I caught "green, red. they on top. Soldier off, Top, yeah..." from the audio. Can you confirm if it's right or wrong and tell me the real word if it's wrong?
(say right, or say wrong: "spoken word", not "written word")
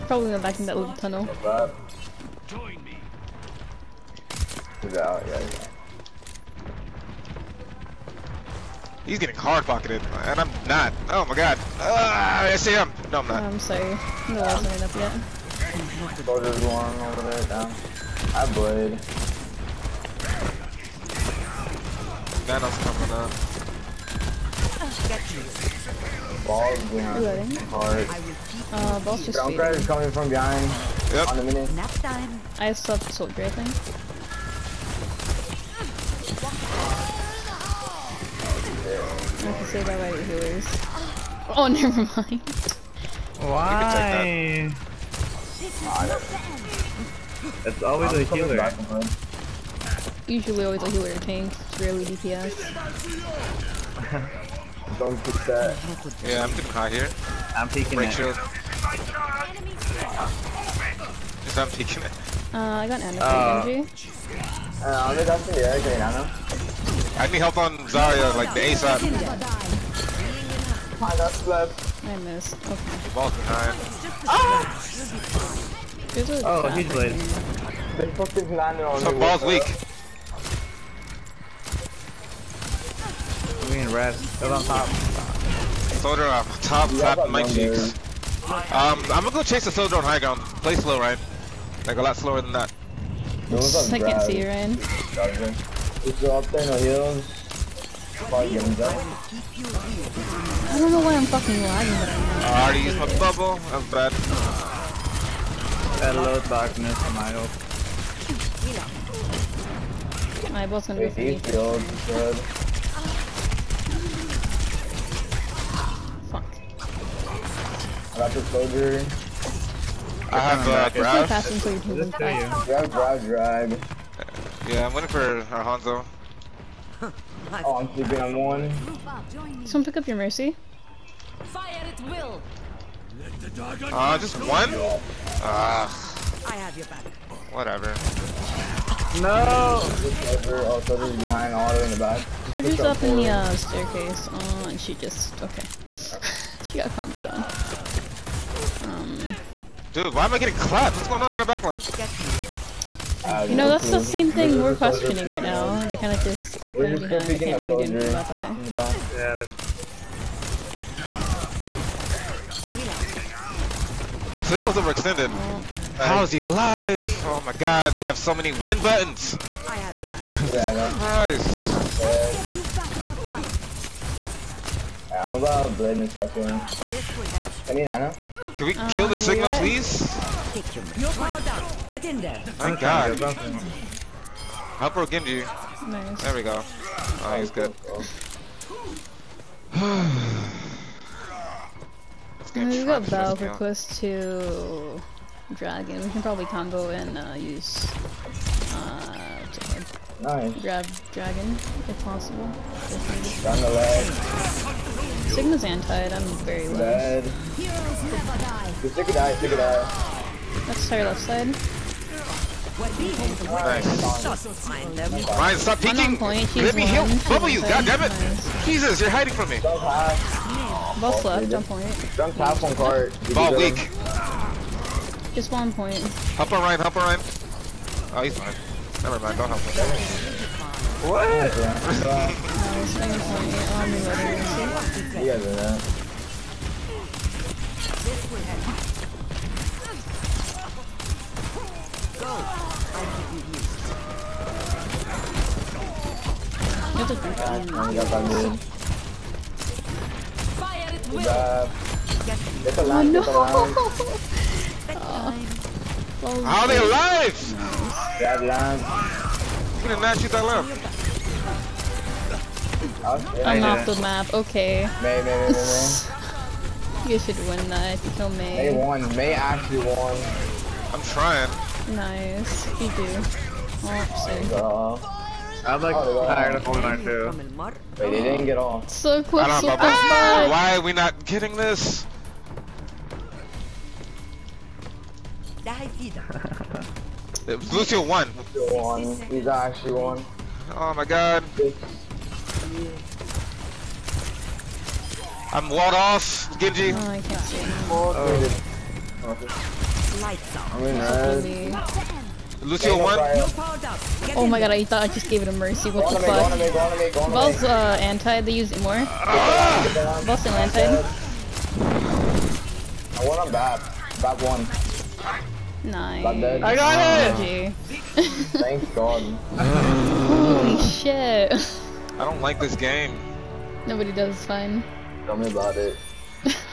right.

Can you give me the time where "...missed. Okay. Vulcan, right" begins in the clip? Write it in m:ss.
1:12.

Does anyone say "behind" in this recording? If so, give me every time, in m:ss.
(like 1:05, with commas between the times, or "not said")
0:30, 2:21.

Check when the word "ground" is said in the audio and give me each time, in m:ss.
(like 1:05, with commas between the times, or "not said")
1:30.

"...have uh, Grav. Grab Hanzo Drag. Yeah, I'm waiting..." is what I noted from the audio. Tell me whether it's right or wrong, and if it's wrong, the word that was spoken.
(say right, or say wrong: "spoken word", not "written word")
wrong: "Grav", not "Hanzo".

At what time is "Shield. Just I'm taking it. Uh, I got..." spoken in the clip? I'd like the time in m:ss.
0:58.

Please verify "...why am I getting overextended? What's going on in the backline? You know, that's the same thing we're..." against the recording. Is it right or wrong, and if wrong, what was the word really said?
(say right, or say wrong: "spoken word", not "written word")
wrong: "clapped", not "overextended".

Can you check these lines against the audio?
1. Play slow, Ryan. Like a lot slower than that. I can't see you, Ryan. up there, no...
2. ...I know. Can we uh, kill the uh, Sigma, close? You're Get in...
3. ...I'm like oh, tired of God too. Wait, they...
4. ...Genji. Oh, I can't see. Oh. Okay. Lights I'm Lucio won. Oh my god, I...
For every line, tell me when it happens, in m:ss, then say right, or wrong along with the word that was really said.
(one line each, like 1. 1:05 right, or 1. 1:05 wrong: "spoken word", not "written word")
1. 1:30 right
2. 2:57 wrong: "please", not "close"
3. 4:35 wrong: "Goldeneye", not "God"
4. 4:56 right.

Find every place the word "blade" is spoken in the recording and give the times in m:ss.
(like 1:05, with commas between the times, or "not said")
0:18, 1:16, 2:55.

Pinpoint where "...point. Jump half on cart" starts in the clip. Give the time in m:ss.
3:41.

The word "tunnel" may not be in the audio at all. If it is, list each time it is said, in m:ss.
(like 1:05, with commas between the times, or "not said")
0:00.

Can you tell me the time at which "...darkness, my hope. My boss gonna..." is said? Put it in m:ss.
1:46.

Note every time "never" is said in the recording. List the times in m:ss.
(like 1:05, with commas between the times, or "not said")
0:41, 3:28, 3:49.